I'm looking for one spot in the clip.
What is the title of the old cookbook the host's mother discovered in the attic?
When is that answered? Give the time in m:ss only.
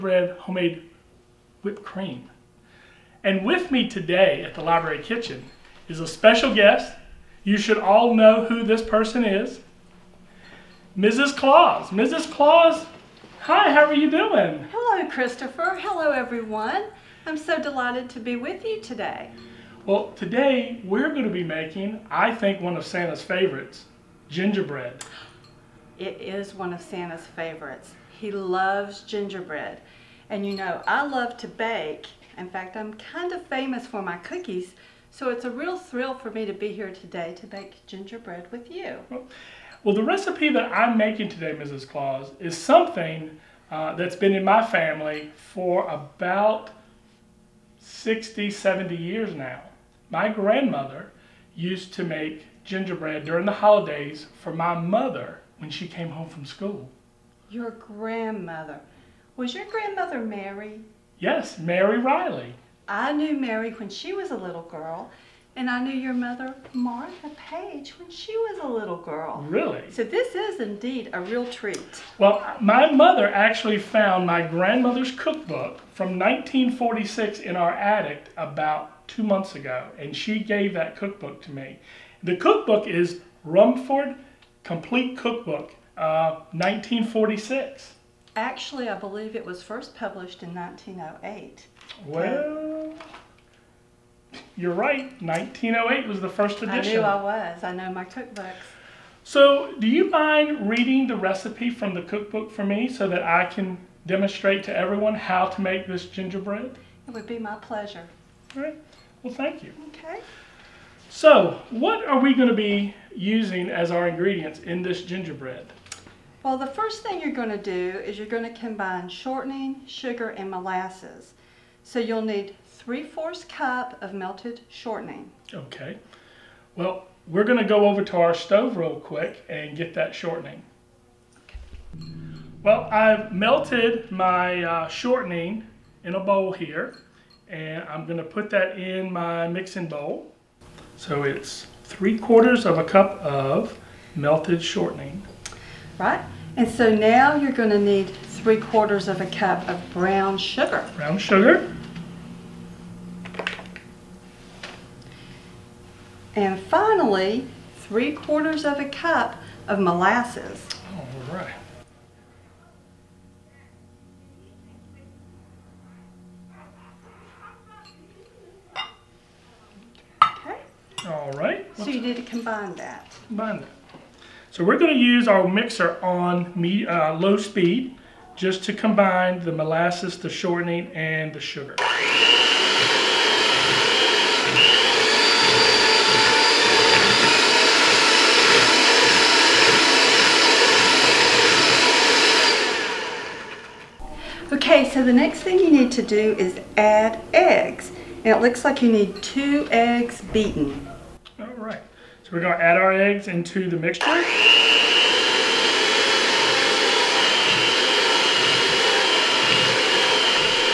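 1:23.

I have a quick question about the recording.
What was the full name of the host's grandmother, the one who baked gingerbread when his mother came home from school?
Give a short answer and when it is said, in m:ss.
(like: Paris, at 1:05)
Mary Riley, at 1:01.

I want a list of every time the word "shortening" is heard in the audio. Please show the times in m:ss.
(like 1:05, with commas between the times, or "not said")
1:59, 2:04, 2:10, 2:14, 2:24, 3:00.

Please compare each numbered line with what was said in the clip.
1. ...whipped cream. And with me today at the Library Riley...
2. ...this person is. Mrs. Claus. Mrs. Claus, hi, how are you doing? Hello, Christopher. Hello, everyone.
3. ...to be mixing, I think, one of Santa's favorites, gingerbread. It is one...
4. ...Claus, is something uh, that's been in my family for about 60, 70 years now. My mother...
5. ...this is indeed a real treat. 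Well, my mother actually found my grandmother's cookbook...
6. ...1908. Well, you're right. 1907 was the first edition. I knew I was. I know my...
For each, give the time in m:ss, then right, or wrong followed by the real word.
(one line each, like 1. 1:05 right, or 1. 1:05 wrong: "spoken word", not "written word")
1. 0:01 wrong: "Kitchen", not "Riley"
2. 0:08 right
3. 0:21 wrong: "making", not "mixing"
4. 0:41 wrong: "grandmother", not "mother"
5. 1:10 right
6. 1:30 wrong: "1908", not "1907".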